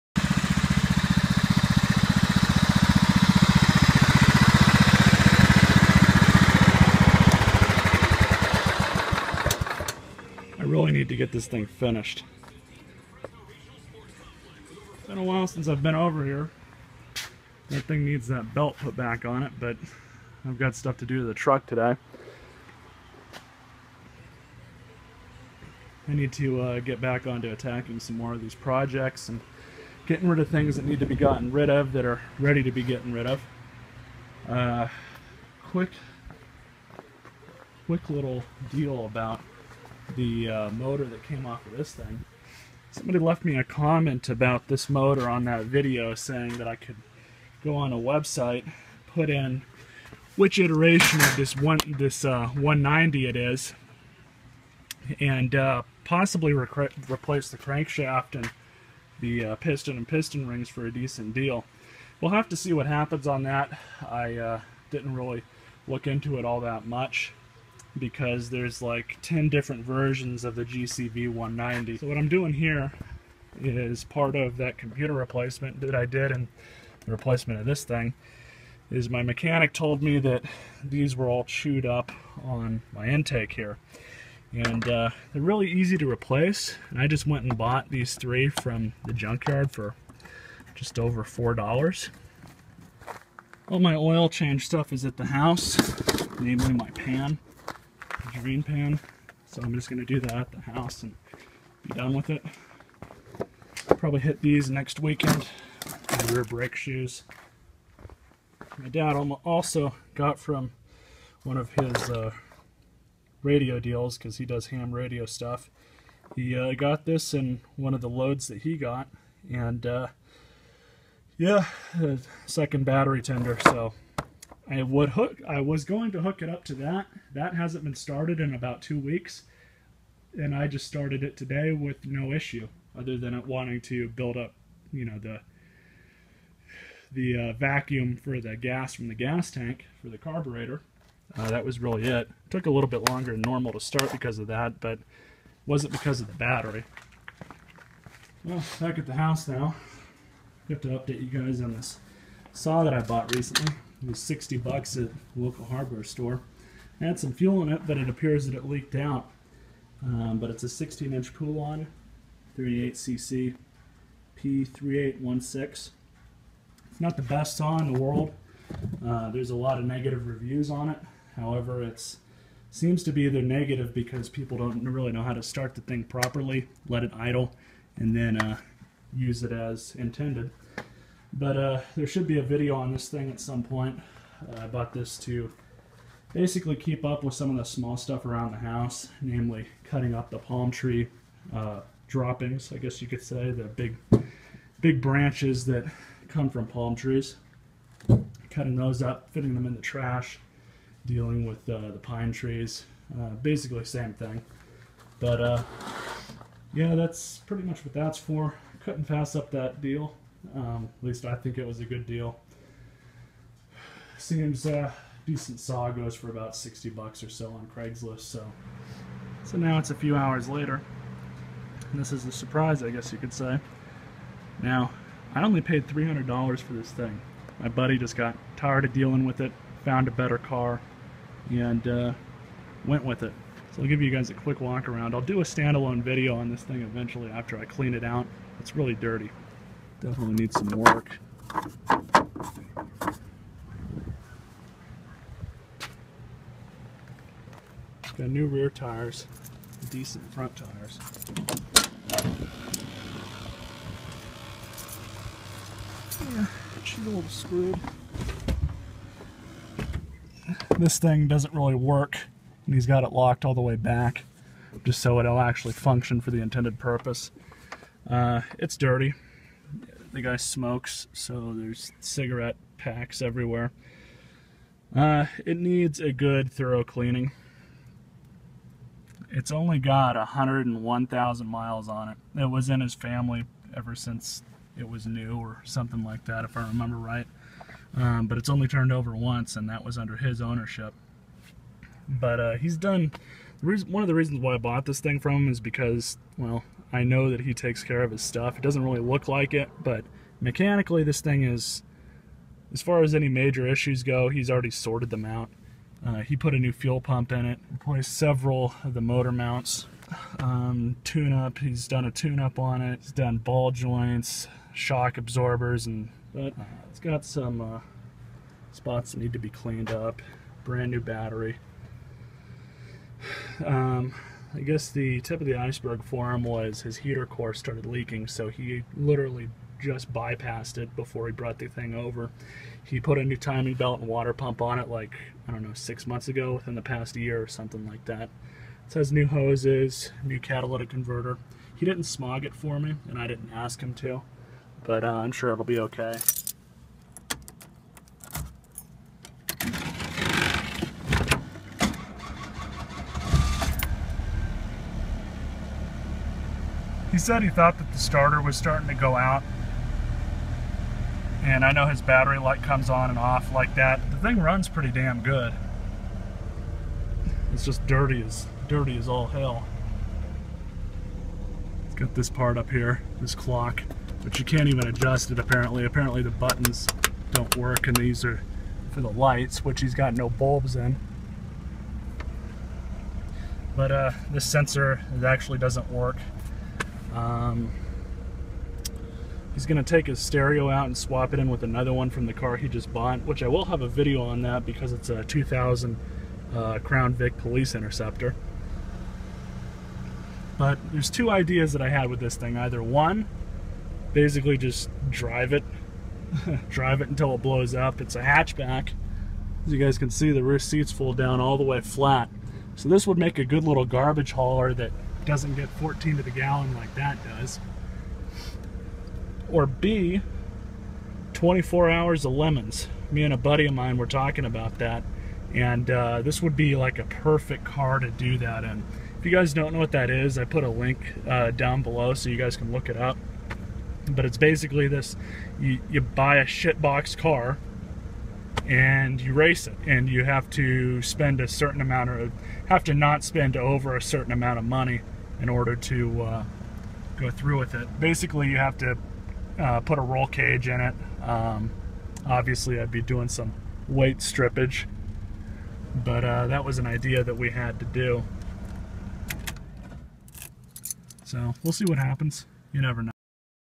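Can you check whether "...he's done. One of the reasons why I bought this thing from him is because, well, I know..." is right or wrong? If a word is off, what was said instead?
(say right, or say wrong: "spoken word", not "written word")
right.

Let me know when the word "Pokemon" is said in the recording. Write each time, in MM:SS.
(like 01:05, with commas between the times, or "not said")
not said.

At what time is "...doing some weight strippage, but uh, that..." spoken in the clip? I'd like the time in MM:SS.
07:33.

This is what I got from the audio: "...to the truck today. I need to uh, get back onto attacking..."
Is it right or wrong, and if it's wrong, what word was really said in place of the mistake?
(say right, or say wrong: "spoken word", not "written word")
right.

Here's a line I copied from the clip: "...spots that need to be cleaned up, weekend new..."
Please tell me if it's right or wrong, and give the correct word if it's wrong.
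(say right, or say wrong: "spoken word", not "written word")
wrong: "brand", not "weekend".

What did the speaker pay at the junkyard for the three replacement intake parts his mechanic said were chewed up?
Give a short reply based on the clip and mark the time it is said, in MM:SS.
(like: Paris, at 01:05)
just over $4, at 01:30.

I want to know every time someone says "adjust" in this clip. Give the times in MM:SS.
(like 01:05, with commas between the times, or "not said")
06:14.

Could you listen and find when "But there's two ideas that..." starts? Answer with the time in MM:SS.
06:40.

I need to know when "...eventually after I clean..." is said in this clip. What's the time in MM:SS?
03:56.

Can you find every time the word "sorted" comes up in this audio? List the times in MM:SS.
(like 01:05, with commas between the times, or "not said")
05:04.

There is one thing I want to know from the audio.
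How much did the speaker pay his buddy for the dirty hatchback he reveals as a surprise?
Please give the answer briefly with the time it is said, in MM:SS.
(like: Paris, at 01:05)
$300, at 03:45.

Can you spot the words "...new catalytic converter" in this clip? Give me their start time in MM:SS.
05:40.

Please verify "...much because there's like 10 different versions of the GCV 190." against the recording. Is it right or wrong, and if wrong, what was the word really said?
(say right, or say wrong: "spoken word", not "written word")
right.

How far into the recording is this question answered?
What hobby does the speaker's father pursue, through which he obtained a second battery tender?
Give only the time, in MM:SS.
01:54.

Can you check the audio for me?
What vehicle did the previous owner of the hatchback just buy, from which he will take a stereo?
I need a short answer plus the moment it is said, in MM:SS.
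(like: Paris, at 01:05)
2000 Crown Vic Police Interceptor, at 06:35.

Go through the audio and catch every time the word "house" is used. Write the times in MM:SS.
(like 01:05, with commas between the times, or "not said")
01:35, 01:40, 02:29, 03:08.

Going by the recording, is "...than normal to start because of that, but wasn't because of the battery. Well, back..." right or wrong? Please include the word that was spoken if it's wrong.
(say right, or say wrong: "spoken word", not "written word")
right.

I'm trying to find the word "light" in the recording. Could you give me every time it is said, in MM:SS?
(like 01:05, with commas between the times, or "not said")
06:02, 06:19.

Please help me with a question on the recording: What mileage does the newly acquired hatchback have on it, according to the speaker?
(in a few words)
101,000 miles.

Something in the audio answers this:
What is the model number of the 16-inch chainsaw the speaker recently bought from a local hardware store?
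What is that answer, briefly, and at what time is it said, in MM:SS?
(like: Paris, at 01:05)
P3816, at 02:44.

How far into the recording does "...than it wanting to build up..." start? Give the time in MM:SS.
02:13.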